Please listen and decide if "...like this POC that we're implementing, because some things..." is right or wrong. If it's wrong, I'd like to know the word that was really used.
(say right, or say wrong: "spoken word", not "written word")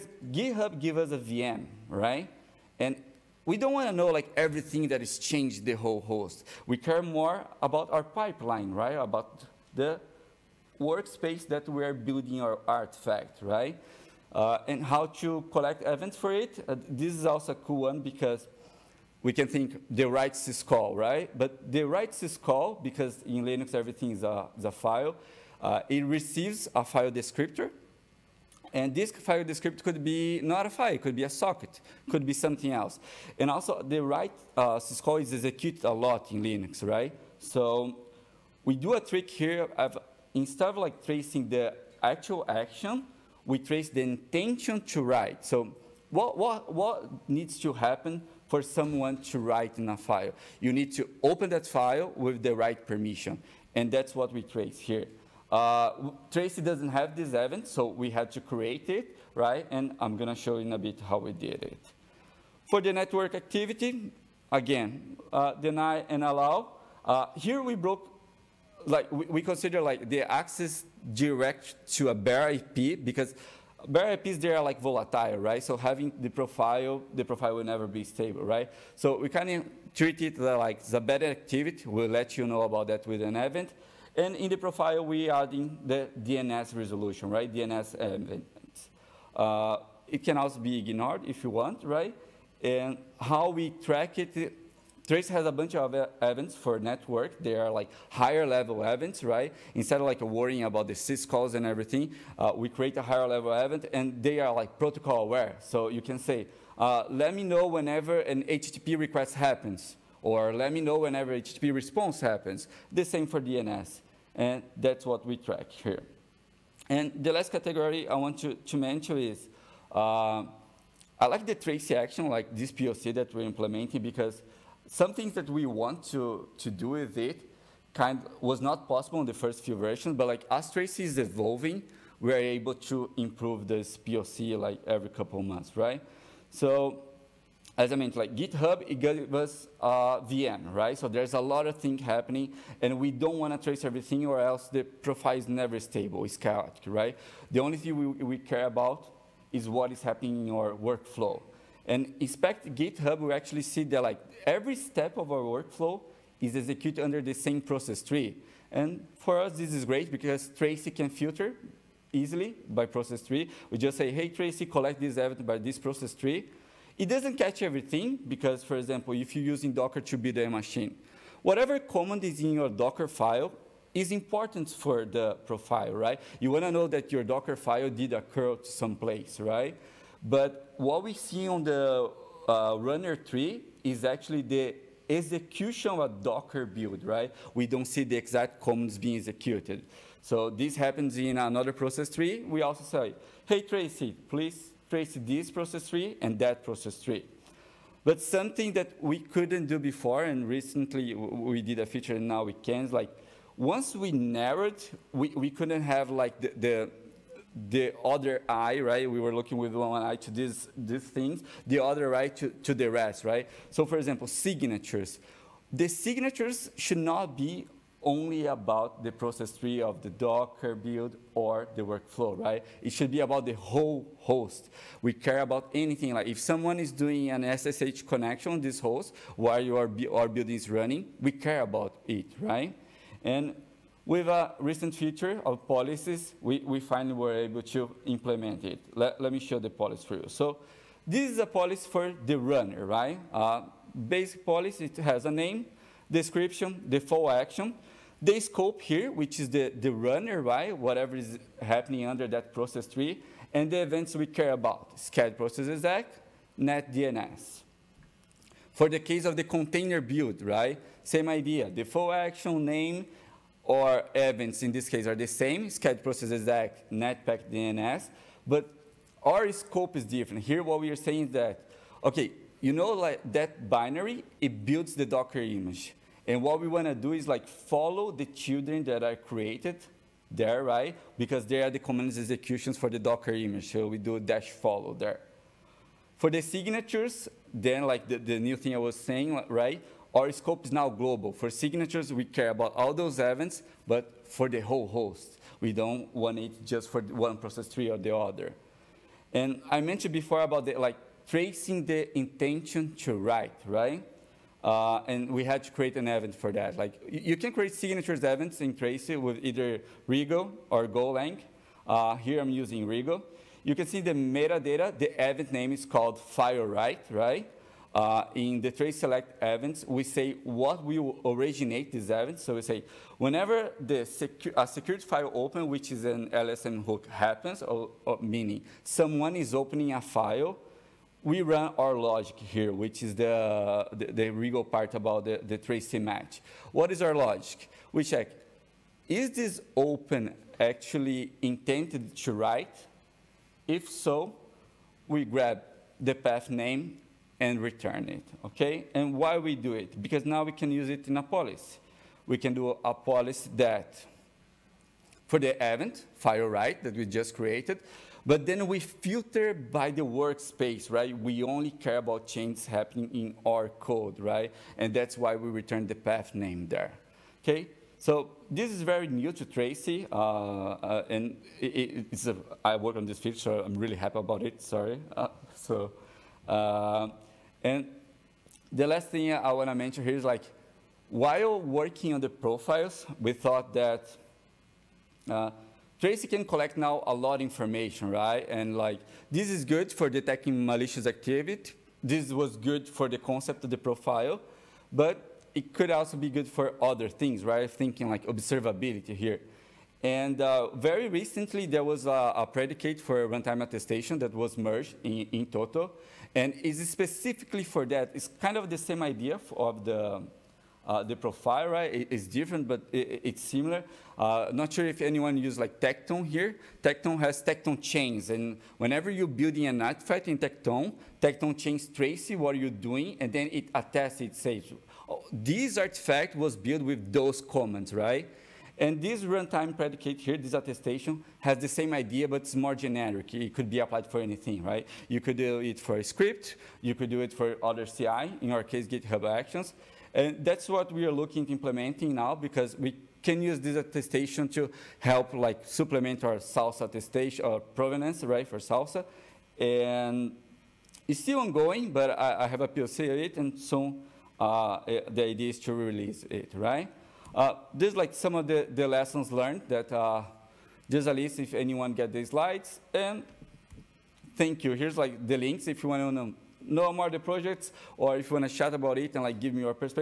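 right.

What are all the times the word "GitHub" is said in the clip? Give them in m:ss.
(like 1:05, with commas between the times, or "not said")
0:00, 2:18, 2:32, 7:18.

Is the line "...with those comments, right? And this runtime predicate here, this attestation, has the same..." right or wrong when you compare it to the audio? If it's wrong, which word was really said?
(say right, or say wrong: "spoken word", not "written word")
right.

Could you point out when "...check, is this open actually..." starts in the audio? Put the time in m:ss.
5:38.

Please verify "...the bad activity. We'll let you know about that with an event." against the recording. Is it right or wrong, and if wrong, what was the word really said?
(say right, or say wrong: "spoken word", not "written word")
right.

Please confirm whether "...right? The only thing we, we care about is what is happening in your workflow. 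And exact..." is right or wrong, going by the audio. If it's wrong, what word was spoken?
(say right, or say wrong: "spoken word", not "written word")
wrong: "inspect", not "exact".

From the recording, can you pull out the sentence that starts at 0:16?
Uh, this is also a cool one because we can think the write syscall, right?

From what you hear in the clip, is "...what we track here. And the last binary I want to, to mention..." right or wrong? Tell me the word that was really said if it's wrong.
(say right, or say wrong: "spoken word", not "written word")
wrong: "category", not "binary".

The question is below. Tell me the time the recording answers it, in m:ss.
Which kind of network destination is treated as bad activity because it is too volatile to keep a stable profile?
1:12.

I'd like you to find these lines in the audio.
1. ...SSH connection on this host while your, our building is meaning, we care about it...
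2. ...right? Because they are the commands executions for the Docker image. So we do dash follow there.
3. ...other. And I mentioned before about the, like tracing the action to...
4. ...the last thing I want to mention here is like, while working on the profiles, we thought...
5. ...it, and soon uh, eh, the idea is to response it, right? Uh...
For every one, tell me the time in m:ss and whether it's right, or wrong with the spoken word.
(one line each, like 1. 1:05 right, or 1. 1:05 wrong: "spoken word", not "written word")
1. 3:47 wrong: "running", not "meaning"
2. 4:40 right
3. 4:58 wrong: "intention", not "action"
4. 6:18 right
5. 7:33 wrong: "release", not "response".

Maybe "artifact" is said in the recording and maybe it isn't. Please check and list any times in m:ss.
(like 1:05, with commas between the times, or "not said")
0:12, 6:59, 7:05.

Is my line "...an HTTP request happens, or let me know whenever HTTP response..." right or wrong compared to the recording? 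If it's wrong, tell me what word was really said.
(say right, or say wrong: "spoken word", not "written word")
right.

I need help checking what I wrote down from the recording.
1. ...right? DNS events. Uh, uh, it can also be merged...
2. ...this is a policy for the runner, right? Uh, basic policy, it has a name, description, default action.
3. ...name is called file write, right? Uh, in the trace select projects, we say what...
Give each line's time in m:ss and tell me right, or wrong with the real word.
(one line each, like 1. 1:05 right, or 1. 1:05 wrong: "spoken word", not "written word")
1. 1:27 wrong: "ignored", not "merged"
2. 4:01 right
3. 5:15 wrong: "events", not "projects".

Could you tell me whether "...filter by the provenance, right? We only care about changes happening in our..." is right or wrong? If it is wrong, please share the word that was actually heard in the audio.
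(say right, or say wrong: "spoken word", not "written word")
wrong: "workspace", not "provenance".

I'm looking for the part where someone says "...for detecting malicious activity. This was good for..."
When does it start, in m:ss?
6:29.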